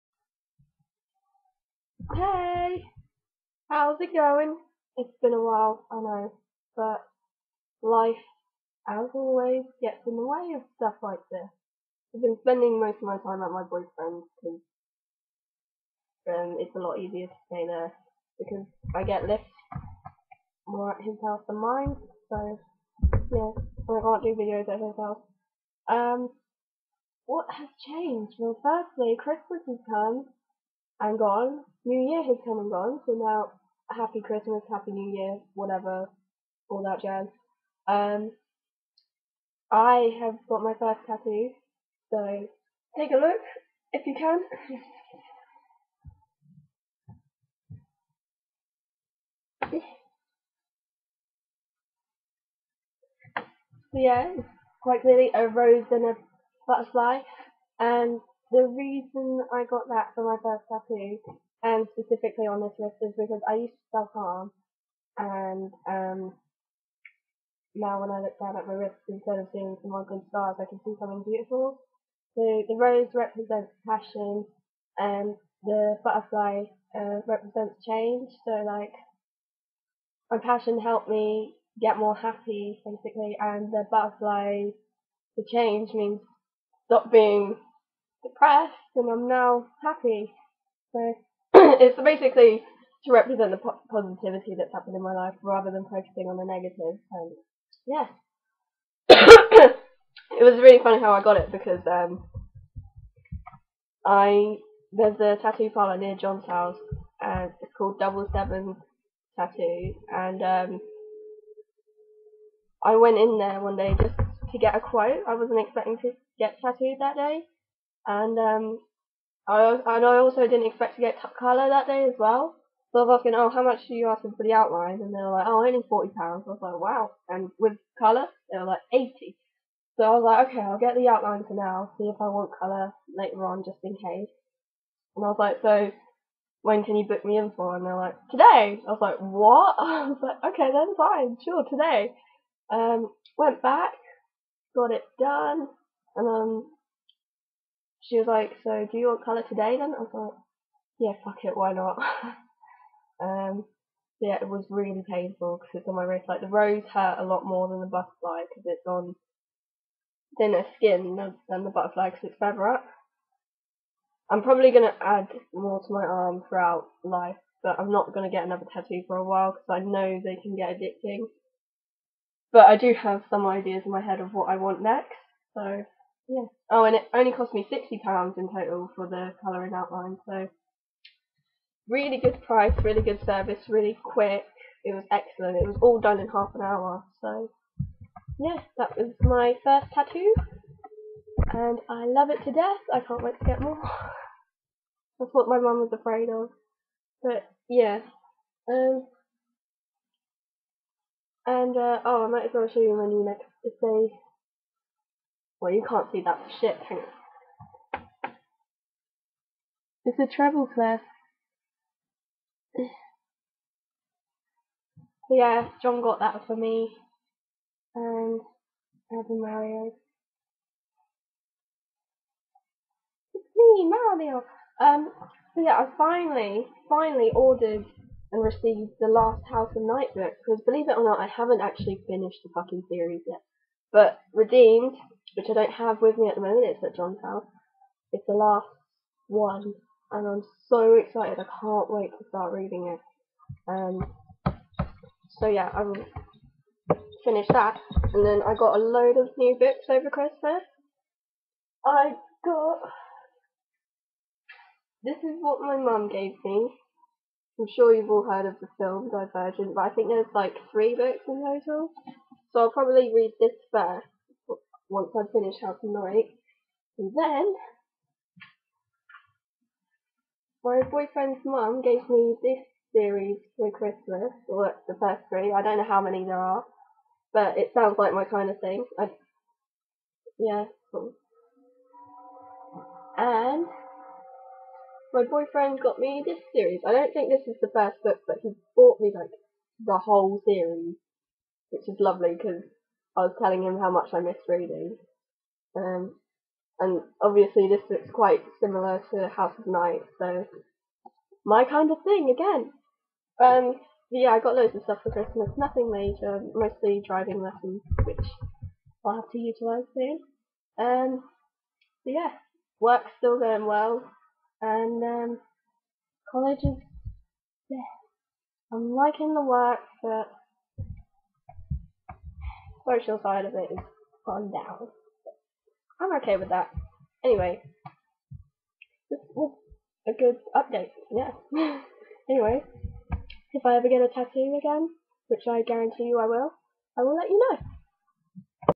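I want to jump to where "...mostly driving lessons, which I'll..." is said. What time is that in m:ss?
5:06.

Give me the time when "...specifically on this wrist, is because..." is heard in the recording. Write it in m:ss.
1:01.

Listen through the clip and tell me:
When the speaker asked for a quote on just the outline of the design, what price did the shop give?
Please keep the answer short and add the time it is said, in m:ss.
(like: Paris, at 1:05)
£40, at 2:05.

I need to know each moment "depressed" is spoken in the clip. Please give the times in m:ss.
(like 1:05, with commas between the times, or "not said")
1:28.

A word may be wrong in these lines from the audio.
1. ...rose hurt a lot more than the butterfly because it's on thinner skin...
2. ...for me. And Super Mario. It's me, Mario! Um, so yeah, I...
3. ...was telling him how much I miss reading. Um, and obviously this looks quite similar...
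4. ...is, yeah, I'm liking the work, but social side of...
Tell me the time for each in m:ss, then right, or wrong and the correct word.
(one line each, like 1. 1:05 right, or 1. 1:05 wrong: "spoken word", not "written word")
1. 2:36 right
2. 3:36 right
3. 4:53 right
4. 5:16 right.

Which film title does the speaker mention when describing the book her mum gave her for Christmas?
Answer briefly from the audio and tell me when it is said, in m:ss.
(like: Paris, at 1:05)
Divergent, at 4:19.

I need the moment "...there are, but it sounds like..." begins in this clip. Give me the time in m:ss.
4:36.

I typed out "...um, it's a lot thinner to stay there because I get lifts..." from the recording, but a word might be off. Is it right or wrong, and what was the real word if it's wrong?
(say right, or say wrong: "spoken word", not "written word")
wrong: "easier", not "thinner".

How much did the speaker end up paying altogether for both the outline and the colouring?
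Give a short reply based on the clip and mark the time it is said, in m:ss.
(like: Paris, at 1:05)
£60, at 2:57.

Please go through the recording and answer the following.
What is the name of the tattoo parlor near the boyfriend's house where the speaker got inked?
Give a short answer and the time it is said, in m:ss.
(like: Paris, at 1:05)
Double Seven Tattoo, at 1:47.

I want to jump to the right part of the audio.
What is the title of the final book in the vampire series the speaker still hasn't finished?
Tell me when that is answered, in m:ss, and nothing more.
3:54.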